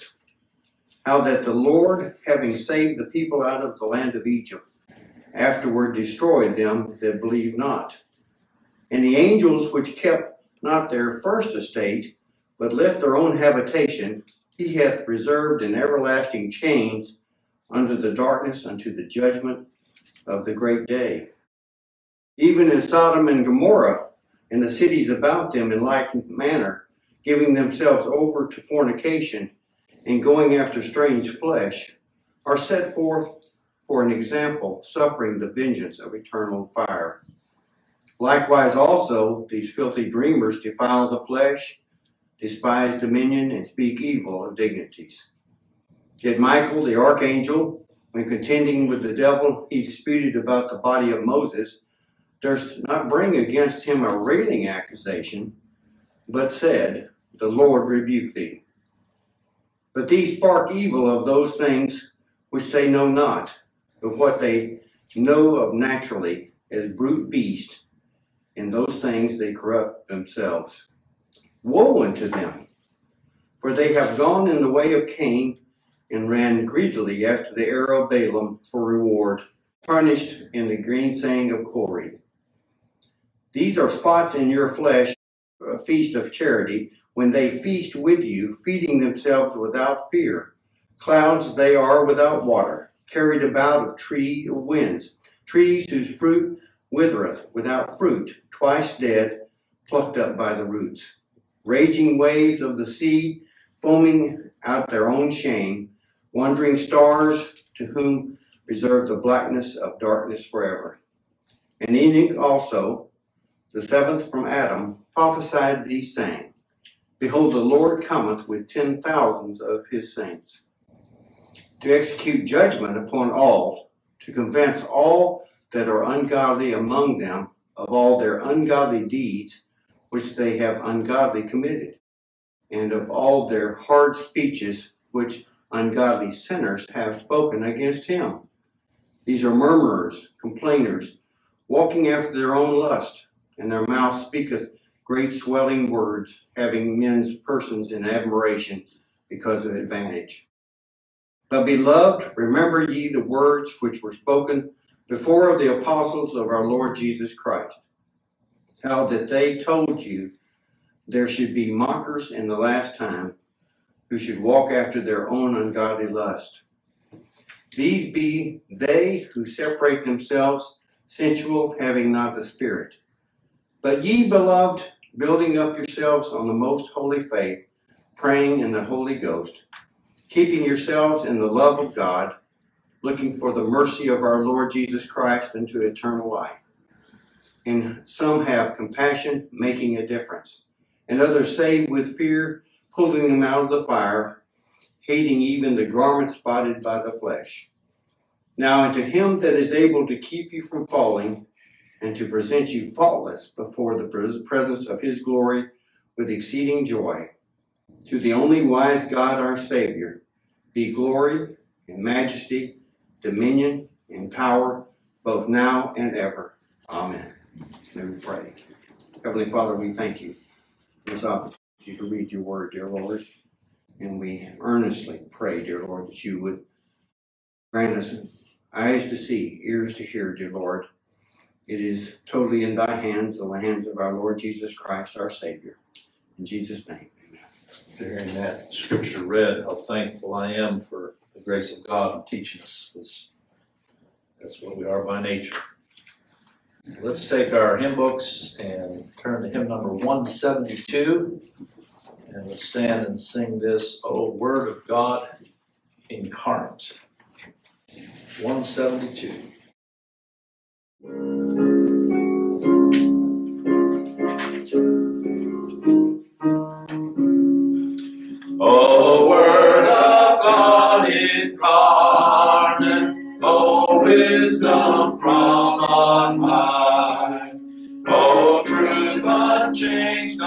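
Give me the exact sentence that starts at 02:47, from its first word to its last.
These be they who separate themselves sensual, having not the Spirit.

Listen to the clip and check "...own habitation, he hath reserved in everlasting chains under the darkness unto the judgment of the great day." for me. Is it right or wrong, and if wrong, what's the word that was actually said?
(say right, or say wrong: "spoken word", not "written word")
right.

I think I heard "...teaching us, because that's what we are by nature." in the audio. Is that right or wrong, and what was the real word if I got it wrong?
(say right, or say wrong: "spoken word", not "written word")
right.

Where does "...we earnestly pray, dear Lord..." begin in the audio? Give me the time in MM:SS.
03:44.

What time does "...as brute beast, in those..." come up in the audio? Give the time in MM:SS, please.
01:06.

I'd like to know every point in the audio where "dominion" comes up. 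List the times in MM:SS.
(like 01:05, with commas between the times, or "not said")
00:43, 03:33.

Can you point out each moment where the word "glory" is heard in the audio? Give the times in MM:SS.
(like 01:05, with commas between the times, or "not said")
03:25, 03:30.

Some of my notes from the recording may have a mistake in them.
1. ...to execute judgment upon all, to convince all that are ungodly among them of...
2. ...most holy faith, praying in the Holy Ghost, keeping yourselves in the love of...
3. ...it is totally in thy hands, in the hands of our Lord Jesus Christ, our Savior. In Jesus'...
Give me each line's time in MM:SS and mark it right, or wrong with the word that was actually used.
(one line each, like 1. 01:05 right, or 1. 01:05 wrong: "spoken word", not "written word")
1. 02:01 right
2. 02:56 right
3. 03:51 right.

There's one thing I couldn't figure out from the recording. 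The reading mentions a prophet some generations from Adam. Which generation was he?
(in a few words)
7th.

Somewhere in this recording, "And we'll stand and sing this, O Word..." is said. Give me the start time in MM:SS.
04:12.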